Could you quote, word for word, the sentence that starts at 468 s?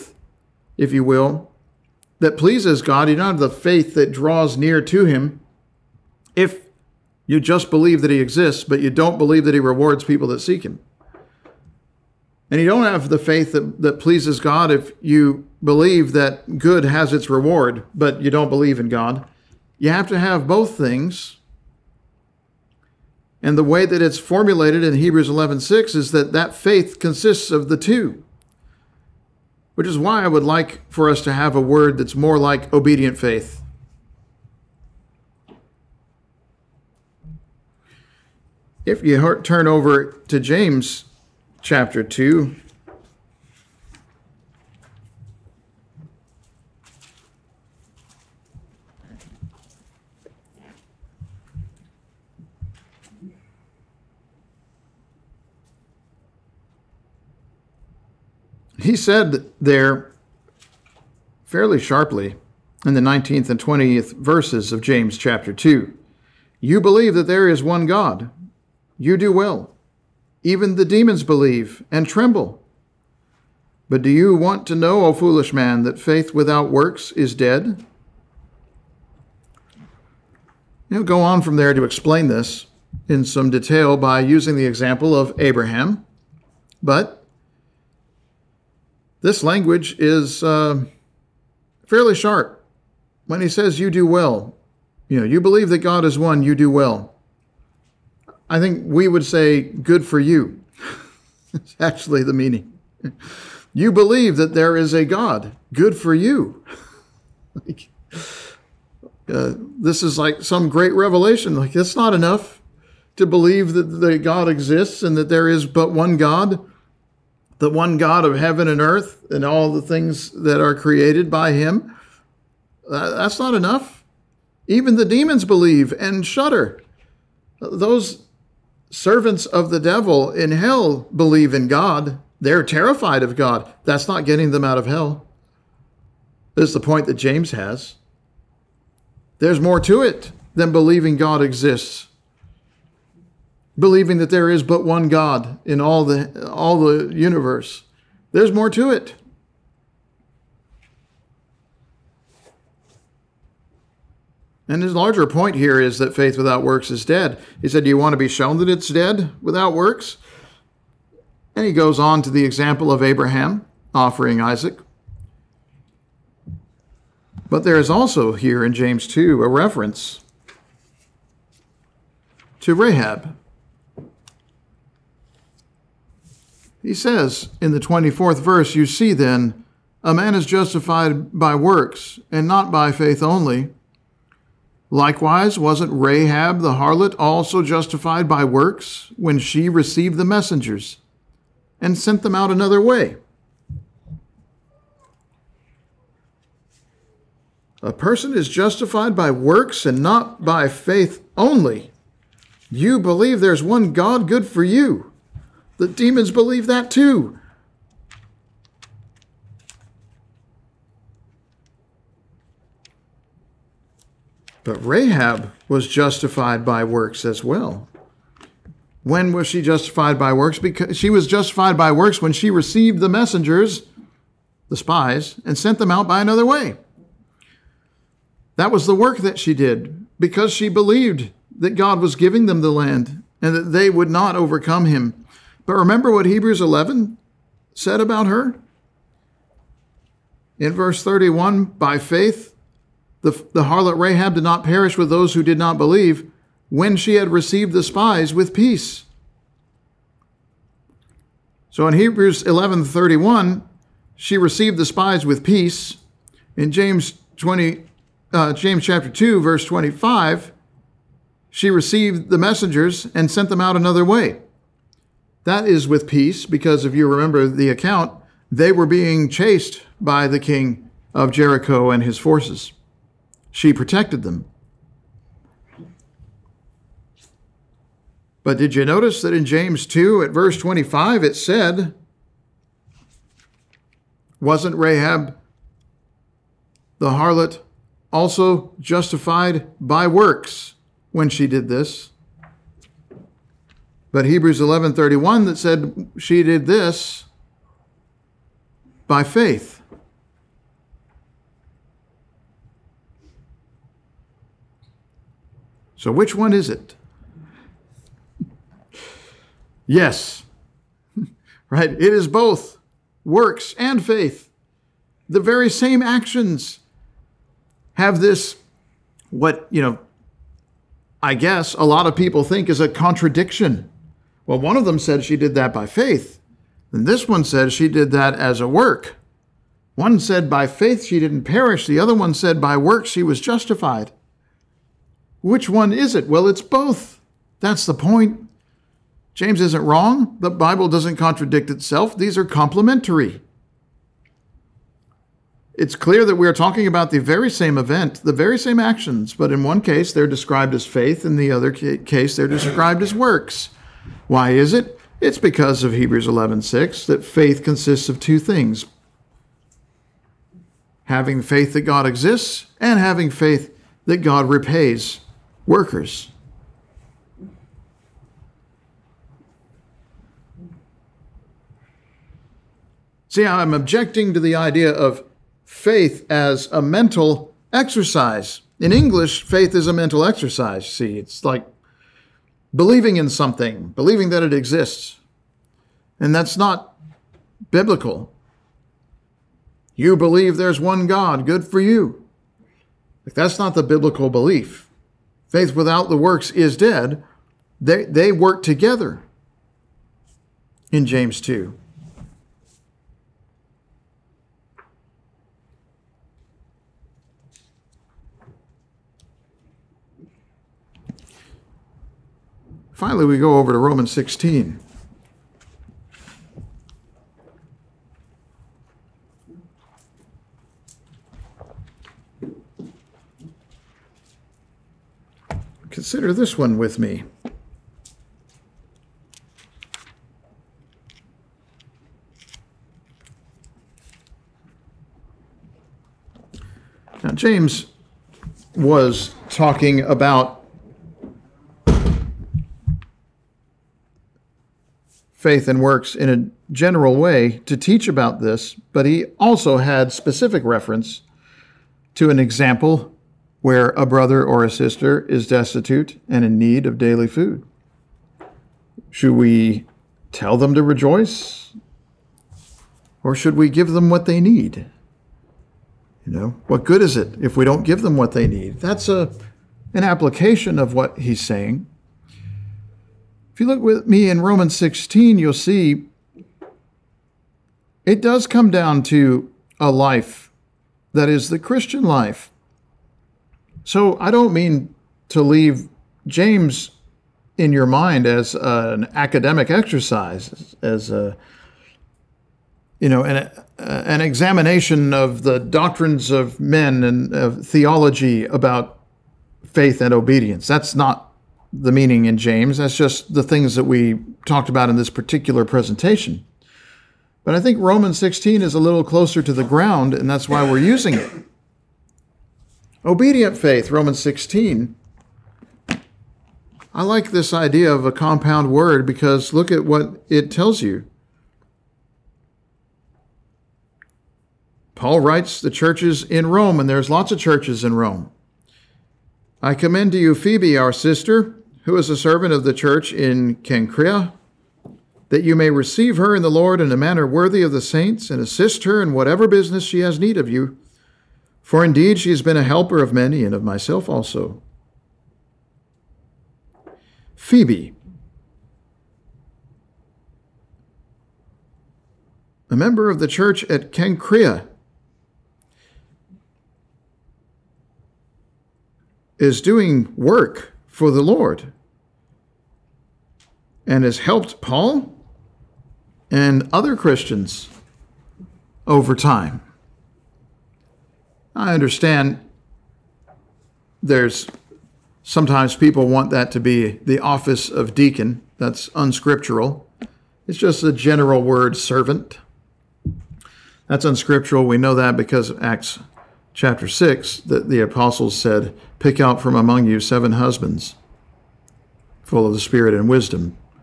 That's a, an application of what he's saying.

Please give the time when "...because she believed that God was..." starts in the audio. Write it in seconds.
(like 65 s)
230 s.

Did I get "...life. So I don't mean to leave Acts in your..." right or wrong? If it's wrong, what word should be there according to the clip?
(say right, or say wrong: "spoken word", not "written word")
wrong: "James", not "Acts".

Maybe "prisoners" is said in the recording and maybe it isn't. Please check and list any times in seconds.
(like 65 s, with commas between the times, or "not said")
not said.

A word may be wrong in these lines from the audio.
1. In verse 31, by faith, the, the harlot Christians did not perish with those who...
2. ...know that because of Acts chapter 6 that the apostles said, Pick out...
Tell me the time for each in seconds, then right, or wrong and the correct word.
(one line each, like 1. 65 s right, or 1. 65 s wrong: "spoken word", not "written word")
1. 240 s wrong: "Rahab", not "Christians"
2. 584 s right.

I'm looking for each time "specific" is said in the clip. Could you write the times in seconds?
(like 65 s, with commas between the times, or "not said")
450 s.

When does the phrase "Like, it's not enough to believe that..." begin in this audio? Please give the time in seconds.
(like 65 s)
111 s.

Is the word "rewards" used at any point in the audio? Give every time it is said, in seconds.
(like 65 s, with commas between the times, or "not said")
9 s, 17 s.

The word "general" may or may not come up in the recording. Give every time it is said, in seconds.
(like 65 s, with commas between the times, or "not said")
446 s, 580 s.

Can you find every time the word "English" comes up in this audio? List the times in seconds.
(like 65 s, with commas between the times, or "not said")
378 s.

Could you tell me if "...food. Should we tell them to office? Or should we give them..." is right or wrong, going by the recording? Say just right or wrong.
wrong.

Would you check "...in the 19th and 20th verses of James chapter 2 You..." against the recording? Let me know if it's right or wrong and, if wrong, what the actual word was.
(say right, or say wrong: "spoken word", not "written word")
right.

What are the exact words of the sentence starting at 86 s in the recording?
But this language is uh, fairly sharp.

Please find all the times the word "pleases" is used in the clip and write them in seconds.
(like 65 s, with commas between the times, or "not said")
2 s, 14 s.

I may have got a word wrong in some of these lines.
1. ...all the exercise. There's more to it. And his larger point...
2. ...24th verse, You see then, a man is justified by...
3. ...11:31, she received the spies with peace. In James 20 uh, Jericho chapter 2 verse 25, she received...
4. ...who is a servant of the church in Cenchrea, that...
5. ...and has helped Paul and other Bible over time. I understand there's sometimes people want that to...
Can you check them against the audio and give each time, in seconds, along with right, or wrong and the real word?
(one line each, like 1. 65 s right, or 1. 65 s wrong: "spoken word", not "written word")
1. 146 s wrong: "universe", not "exercise"
2. 177 s right
3. 252 s wrong: "James", not "Jericho"
4. 531 s right
5. 563 s wrong: "Christians", not "Bible".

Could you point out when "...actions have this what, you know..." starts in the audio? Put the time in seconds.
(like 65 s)
316 s.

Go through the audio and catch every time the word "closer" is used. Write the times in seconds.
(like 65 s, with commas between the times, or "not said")
509 s.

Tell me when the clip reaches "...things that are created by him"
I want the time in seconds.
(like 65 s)
119 s.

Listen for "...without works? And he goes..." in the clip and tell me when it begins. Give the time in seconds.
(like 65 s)
159 s.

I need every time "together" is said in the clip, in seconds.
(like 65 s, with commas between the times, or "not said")
398 s.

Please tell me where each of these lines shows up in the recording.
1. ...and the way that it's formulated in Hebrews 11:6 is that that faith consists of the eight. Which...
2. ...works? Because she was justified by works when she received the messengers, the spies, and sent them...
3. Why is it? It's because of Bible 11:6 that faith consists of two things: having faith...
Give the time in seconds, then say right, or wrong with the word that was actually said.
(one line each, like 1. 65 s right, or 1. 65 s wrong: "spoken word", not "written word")
1. 23 s wrong: "two", not "eight"
2. 220 s right
3. 354 s wrong: "Hebrews", not "Bible".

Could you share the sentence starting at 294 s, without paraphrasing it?
But Hebrews 11:31 that said she did this by faith.